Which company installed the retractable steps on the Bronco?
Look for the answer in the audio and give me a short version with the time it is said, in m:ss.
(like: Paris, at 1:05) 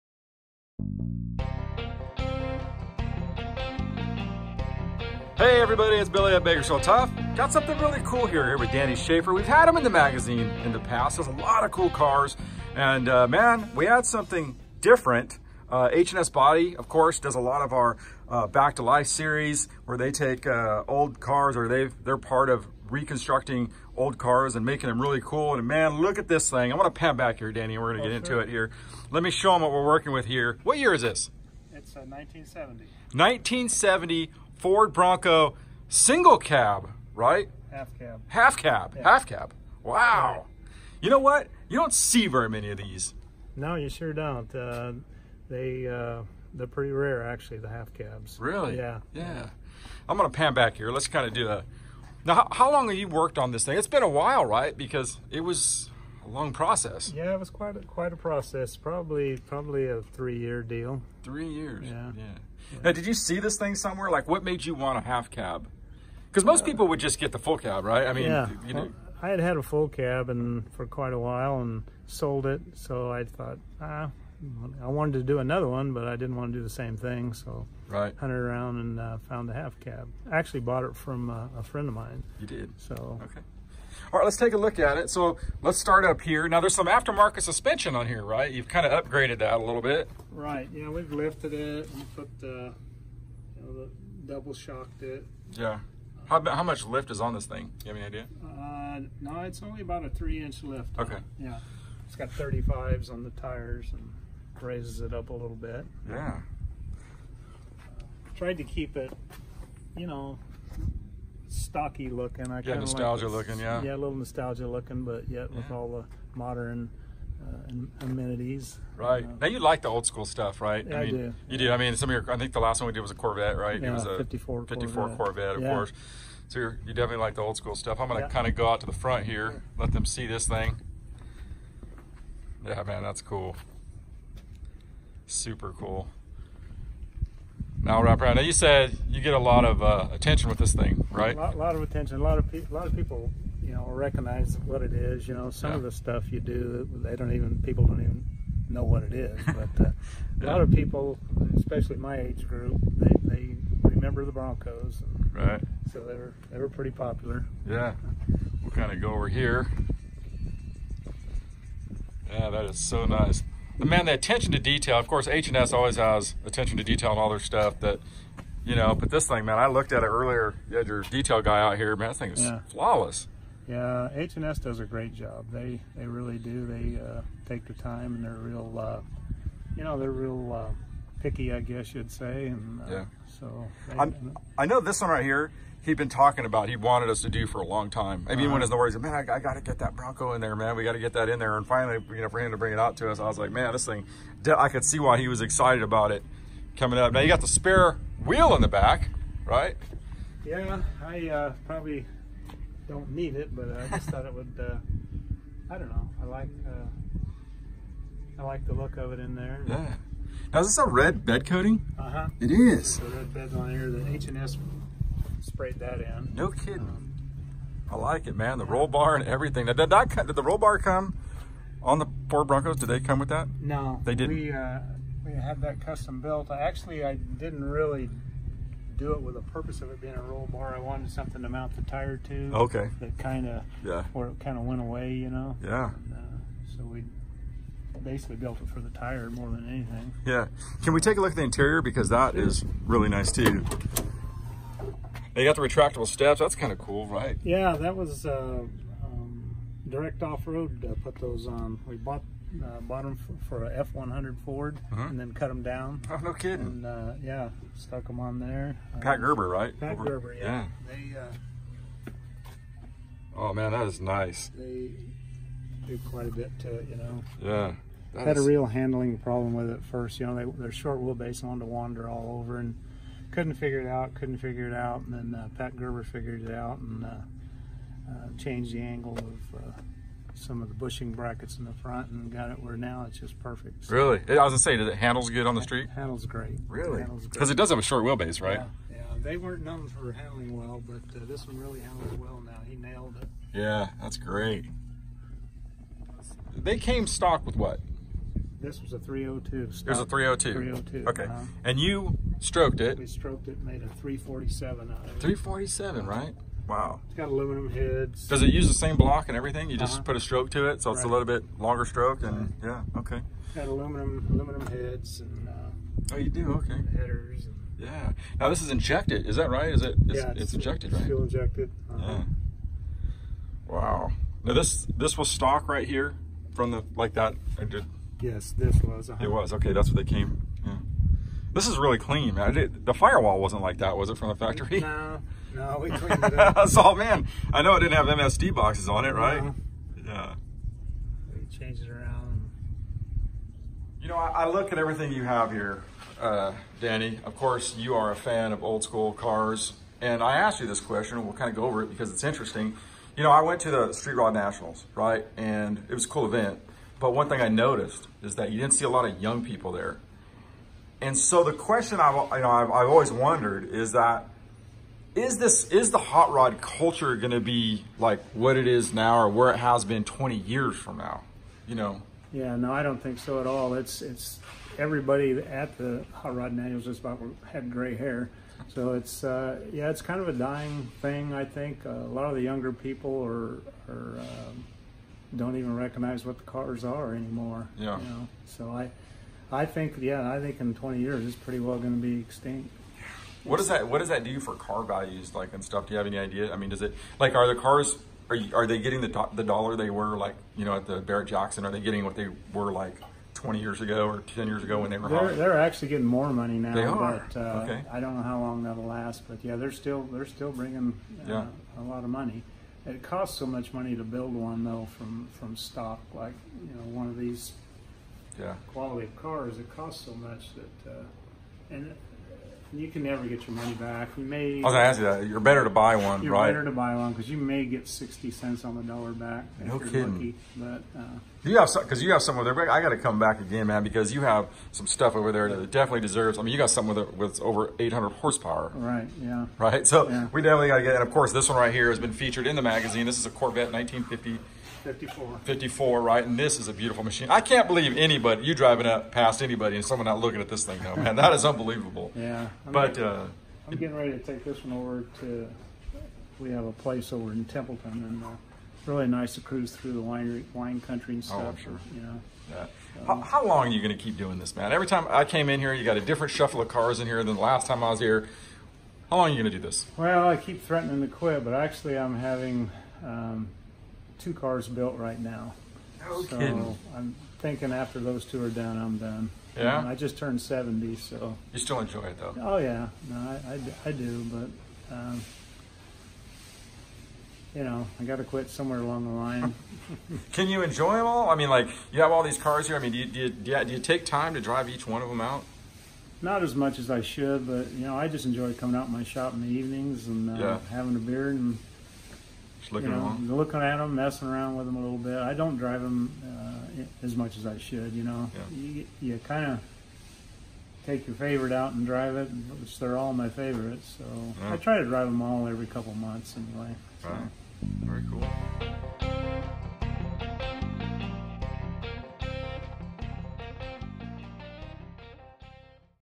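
Direct Off-Road, at 4:09.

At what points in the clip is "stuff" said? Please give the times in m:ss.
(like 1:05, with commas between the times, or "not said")
2:00, 2:07, 2:25, 2:47, 6:35, 7:14, 7:41.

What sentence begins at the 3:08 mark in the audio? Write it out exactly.
I mean, uh, when his Lord said, "Man, I, I got to get that Bronco in there, man.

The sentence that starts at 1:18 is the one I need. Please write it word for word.
hunted around and uh, found a half cab.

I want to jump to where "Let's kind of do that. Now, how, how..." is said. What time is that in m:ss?
0:50.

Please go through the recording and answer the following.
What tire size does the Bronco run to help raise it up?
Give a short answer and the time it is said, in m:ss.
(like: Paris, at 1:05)
35s, at 1:42.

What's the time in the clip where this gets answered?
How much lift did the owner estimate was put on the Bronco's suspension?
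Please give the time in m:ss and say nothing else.
1:40.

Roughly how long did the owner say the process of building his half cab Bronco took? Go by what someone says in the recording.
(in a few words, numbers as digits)
3 years.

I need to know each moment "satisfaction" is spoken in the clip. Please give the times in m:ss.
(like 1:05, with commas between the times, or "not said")
not said.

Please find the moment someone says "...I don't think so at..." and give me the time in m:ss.
6:12.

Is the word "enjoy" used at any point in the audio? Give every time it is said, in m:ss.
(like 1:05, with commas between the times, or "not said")
8:01, 8:10, 8:18.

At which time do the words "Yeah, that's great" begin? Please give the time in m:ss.
4:53.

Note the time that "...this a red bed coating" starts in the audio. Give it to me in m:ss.
3:30.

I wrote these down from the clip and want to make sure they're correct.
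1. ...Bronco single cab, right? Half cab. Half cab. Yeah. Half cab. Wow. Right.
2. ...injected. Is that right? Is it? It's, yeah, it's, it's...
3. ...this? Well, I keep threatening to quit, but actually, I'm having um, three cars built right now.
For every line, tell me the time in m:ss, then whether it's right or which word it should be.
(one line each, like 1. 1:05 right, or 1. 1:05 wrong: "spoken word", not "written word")
1. 0:34 right
2. 5:18 right
3. 7:49 wrong: "two", not "three".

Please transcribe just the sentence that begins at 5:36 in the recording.
all, man, I know it didn't have MSD boxes on it, right?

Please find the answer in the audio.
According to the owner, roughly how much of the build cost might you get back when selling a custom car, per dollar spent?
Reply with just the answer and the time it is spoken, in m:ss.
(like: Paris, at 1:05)
60 cents, at 7:07.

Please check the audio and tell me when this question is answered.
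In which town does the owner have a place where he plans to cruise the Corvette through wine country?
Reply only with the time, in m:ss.
7:37.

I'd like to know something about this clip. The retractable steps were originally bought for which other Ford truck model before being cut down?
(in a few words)
F100.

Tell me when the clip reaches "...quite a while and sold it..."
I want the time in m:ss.
1:10.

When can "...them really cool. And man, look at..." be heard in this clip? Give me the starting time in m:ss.
0:24.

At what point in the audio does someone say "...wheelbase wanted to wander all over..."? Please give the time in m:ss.
4:30.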